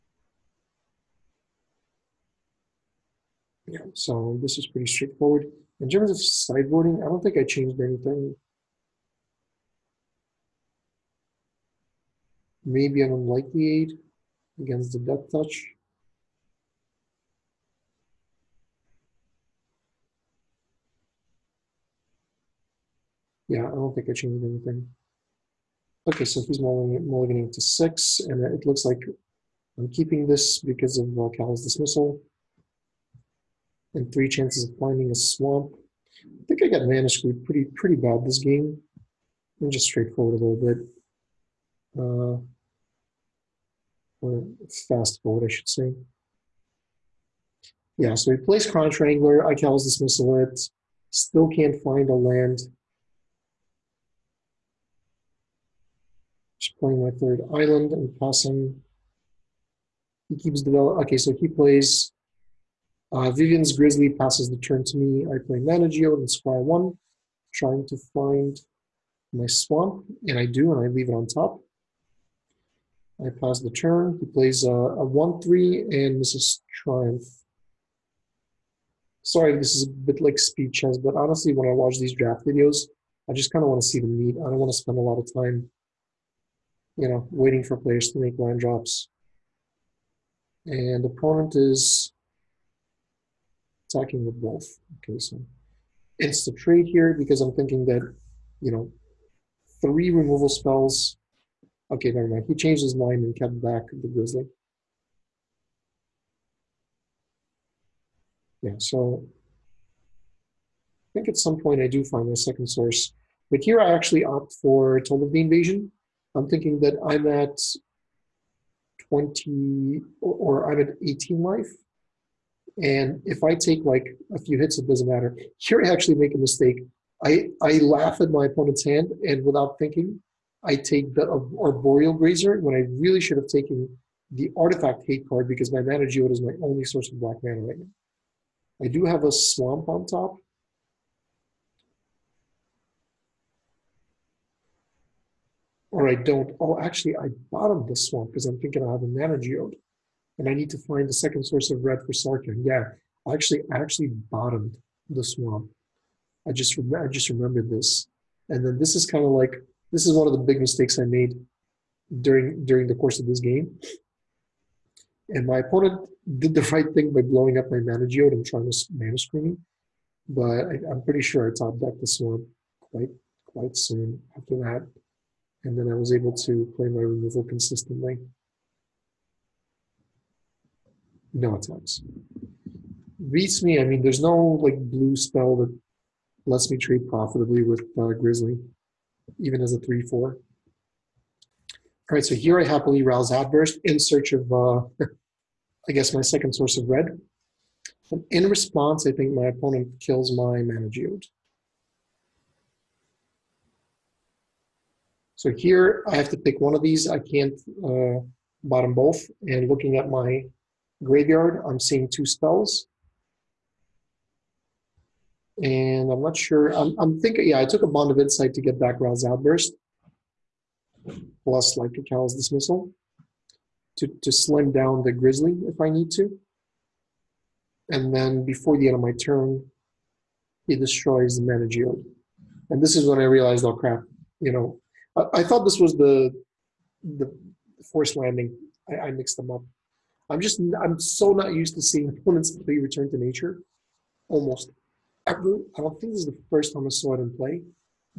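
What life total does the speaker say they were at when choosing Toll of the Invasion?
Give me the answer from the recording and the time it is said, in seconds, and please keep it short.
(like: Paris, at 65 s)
18, at 121 s.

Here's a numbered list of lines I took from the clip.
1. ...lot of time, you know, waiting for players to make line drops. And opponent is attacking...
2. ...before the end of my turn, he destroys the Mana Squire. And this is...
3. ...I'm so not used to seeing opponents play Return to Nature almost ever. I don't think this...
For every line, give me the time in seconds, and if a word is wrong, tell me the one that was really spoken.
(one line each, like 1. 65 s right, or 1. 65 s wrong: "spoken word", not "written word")
1. 85 s right
2. 228 s wrong: "Geode", not "Squire"
3. 240 s right.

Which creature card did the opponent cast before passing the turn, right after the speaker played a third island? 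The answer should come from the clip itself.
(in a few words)
Vivien's Grizzly.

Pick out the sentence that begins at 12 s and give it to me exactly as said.
Maybe an unlikely aid against the death touch.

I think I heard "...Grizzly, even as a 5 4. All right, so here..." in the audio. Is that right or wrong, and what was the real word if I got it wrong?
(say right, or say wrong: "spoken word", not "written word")
wrong: "3", not "5".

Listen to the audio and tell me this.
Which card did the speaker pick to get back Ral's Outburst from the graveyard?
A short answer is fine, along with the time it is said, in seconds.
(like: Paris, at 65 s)
Bond of Insight, at 217 s.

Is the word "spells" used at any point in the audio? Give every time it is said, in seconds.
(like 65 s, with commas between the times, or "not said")
100 s, 185 s, 212 s.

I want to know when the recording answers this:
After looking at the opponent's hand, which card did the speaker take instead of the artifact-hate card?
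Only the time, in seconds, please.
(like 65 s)
131 s.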